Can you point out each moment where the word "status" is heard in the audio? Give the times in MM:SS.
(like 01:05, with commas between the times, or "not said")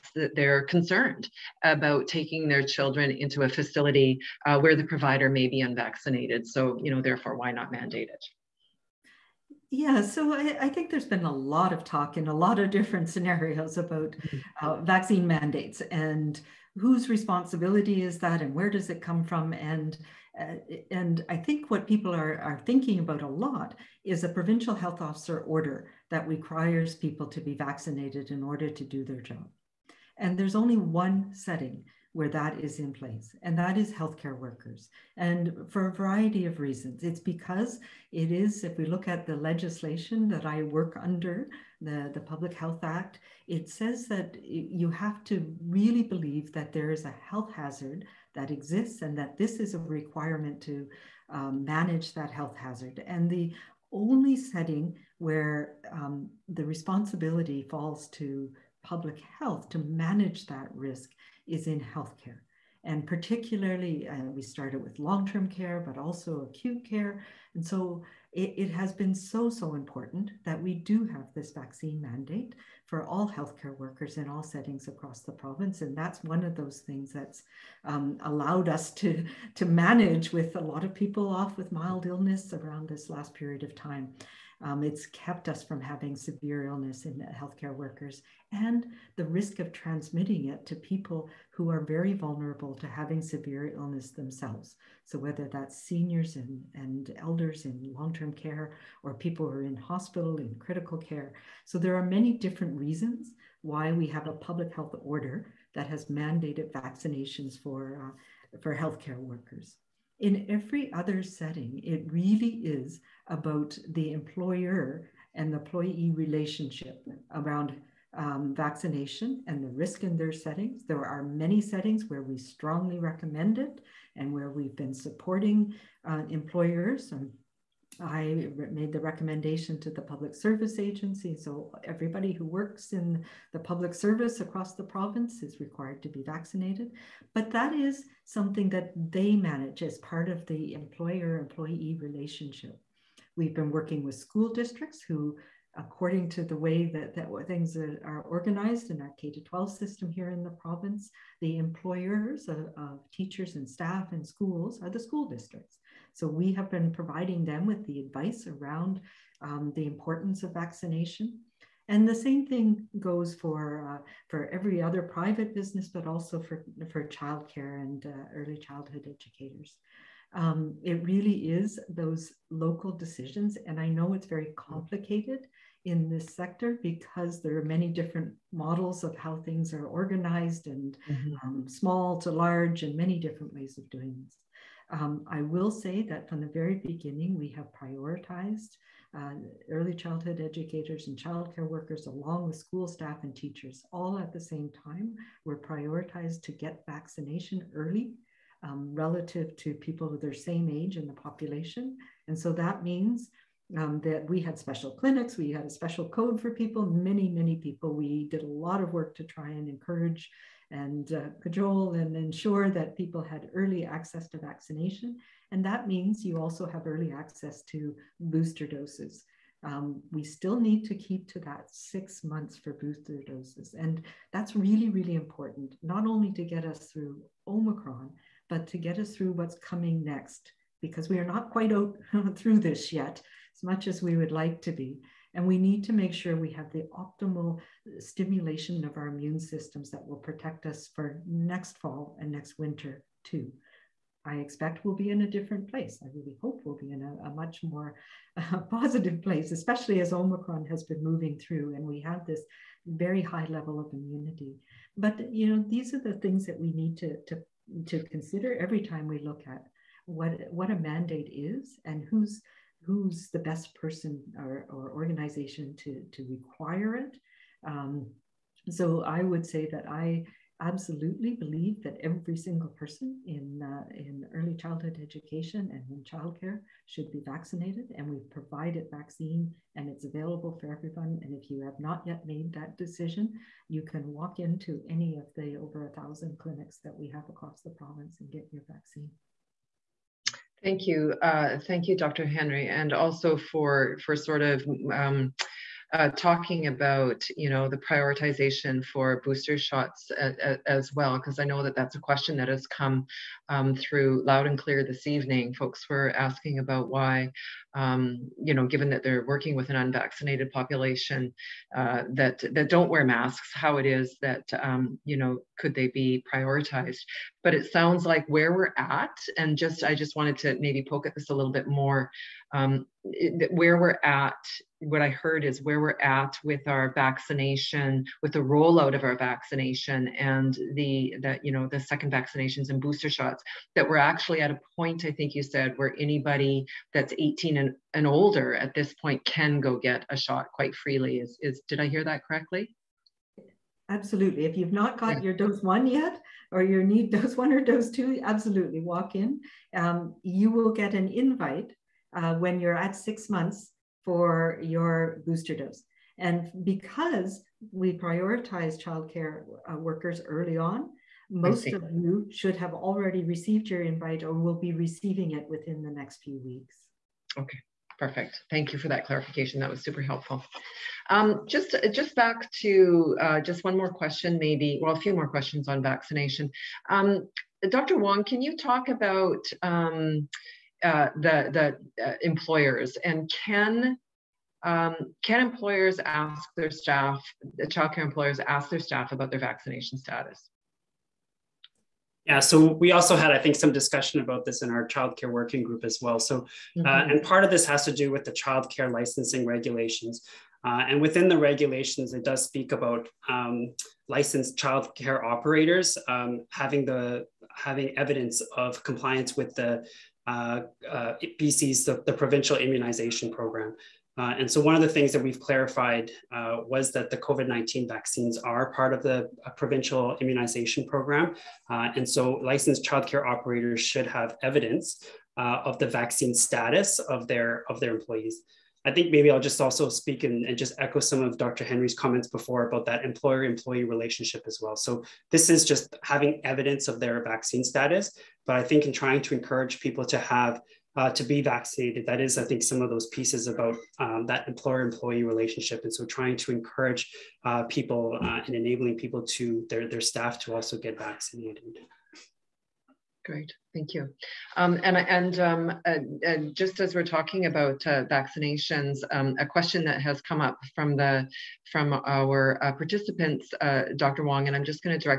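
06:29, 07:06, 07:17.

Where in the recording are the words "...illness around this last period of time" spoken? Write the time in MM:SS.
01:22.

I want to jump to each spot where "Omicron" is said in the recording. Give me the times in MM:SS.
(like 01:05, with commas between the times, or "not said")
03:47, 04:10.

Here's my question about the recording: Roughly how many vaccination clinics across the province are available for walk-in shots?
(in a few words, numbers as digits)
over 1,000.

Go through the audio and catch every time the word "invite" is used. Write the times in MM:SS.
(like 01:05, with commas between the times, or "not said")
05:51, 06:03.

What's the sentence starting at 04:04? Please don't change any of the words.
I expect we'll be in a different place.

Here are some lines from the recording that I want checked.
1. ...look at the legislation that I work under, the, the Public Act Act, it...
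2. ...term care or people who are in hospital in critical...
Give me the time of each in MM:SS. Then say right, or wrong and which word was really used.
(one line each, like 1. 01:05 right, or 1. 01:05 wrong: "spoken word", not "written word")
1. 00:38 wrong: "Health", not "Act"
2. 01:38 right.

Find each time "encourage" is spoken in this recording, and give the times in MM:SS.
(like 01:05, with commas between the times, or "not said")
03:29, 07:19, 07:26.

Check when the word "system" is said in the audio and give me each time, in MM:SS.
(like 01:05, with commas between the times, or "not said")
02:29, 03:59.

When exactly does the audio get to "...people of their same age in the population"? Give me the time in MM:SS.
03:19.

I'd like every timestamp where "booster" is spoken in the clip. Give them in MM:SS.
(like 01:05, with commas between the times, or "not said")
03:38, 03:42, 04:59, 05:32, 05:55.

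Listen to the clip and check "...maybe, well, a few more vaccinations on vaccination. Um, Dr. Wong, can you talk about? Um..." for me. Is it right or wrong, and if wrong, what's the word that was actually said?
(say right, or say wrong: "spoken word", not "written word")
wrong: "questions", not "vaccinations".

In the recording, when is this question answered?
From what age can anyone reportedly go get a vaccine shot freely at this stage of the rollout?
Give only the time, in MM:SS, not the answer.
05:37.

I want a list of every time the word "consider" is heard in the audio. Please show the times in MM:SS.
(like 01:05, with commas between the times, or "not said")
04:18.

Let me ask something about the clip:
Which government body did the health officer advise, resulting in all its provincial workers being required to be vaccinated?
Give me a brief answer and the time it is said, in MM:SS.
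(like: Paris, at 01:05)
public service agency, at 02:10.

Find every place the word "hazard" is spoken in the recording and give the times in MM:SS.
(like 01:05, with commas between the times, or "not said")
00:47, 00:52.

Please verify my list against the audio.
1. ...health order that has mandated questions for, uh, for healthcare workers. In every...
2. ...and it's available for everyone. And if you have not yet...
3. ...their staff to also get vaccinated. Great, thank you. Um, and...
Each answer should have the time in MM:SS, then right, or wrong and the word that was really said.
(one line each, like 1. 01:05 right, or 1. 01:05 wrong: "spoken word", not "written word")
1. 01:44 wrong: "vaccinations", not "questions"
2. 04:39 right
3. 07:29 right.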